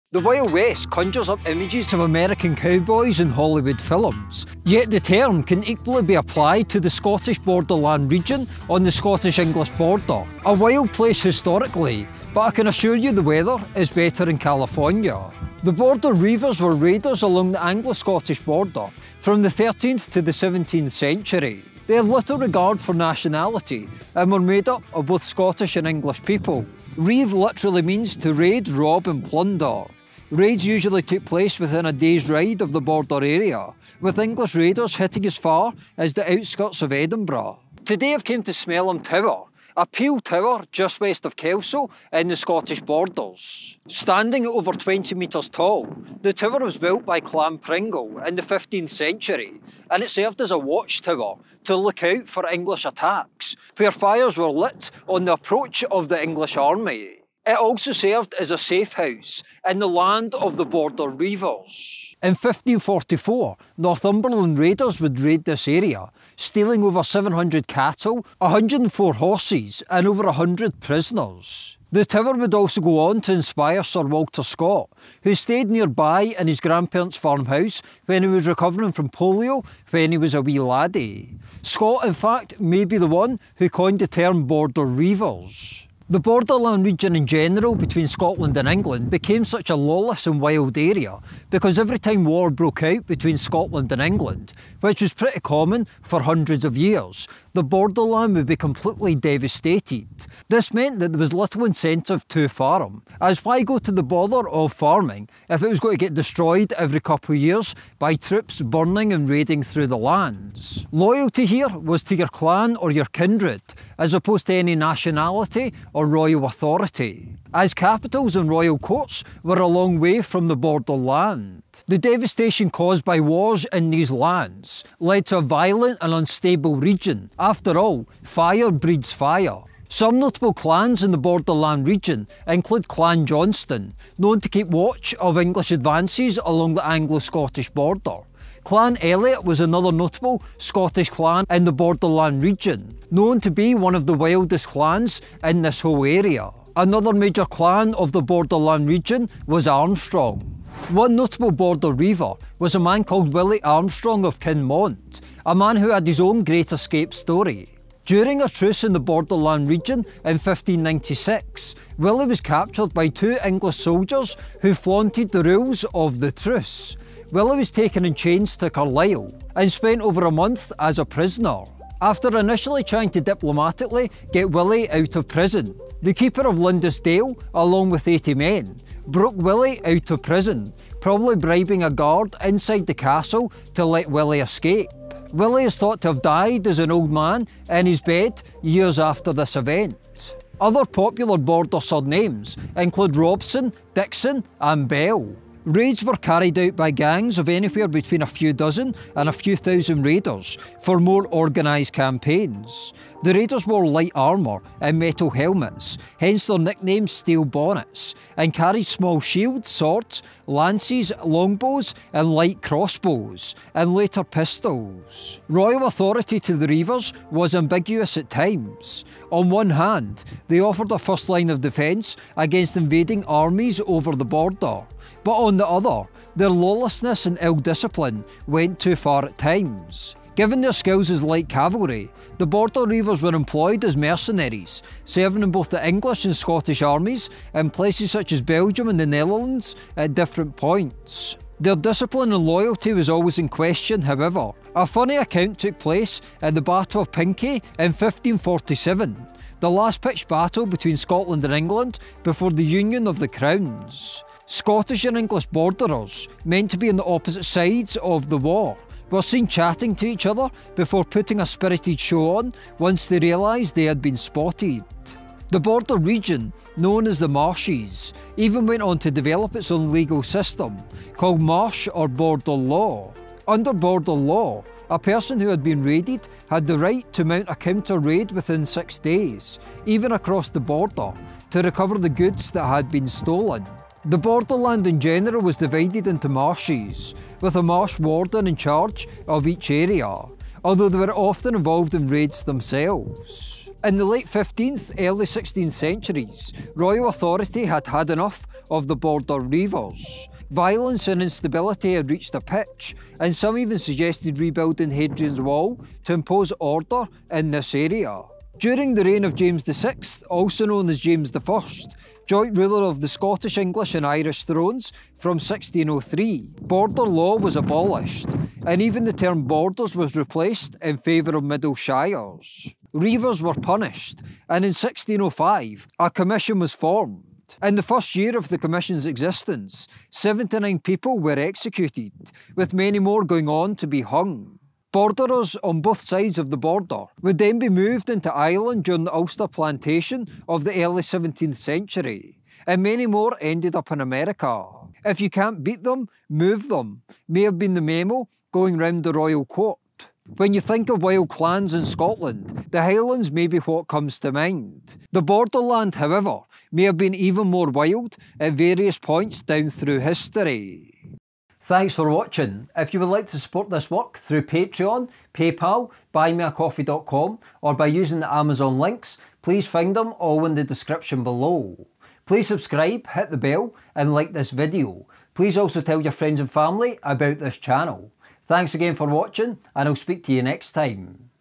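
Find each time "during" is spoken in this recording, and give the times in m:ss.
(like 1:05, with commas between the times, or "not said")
2:38, 5:08, 5:38.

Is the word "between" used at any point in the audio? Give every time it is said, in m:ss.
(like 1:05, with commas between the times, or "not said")
1:27, 1:33, 3:17, 4:10.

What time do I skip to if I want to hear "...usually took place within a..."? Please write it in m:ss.
0:30.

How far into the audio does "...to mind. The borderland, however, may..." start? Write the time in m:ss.
5:54.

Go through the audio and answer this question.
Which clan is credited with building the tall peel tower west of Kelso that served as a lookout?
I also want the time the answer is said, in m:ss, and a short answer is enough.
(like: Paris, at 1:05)
Clan Pringle, at 0:47.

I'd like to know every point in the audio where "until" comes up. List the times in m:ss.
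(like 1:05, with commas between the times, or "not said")
not said.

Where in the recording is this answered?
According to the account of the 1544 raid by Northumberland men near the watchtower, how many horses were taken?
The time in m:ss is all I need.
1:08.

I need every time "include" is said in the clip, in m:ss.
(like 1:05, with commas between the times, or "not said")
2:12, 3:12.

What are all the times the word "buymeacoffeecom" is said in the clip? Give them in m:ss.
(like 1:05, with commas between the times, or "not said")
6:06.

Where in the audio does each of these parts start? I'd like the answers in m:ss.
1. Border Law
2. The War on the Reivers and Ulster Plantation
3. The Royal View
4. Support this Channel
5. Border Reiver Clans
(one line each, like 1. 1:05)
1. 4:25
2. 4:53
3. 3:34
4. 6:01
5. 2:08.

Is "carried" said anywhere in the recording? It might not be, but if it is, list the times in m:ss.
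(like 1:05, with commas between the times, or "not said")
3:16, 3:28.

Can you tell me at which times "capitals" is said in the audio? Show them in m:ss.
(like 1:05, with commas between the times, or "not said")
1:57.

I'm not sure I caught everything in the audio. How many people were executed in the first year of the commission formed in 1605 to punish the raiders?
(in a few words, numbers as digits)
79.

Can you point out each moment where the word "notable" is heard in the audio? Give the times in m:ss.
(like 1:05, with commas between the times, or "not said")
2:10, 2:19, 2:31.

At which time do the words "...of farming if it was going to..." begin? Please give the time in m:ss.
1:44.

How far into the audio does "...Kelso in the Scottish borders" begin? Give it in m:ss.
0:41.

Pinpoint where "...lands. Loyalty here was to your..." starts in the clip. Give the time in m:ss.
1:49.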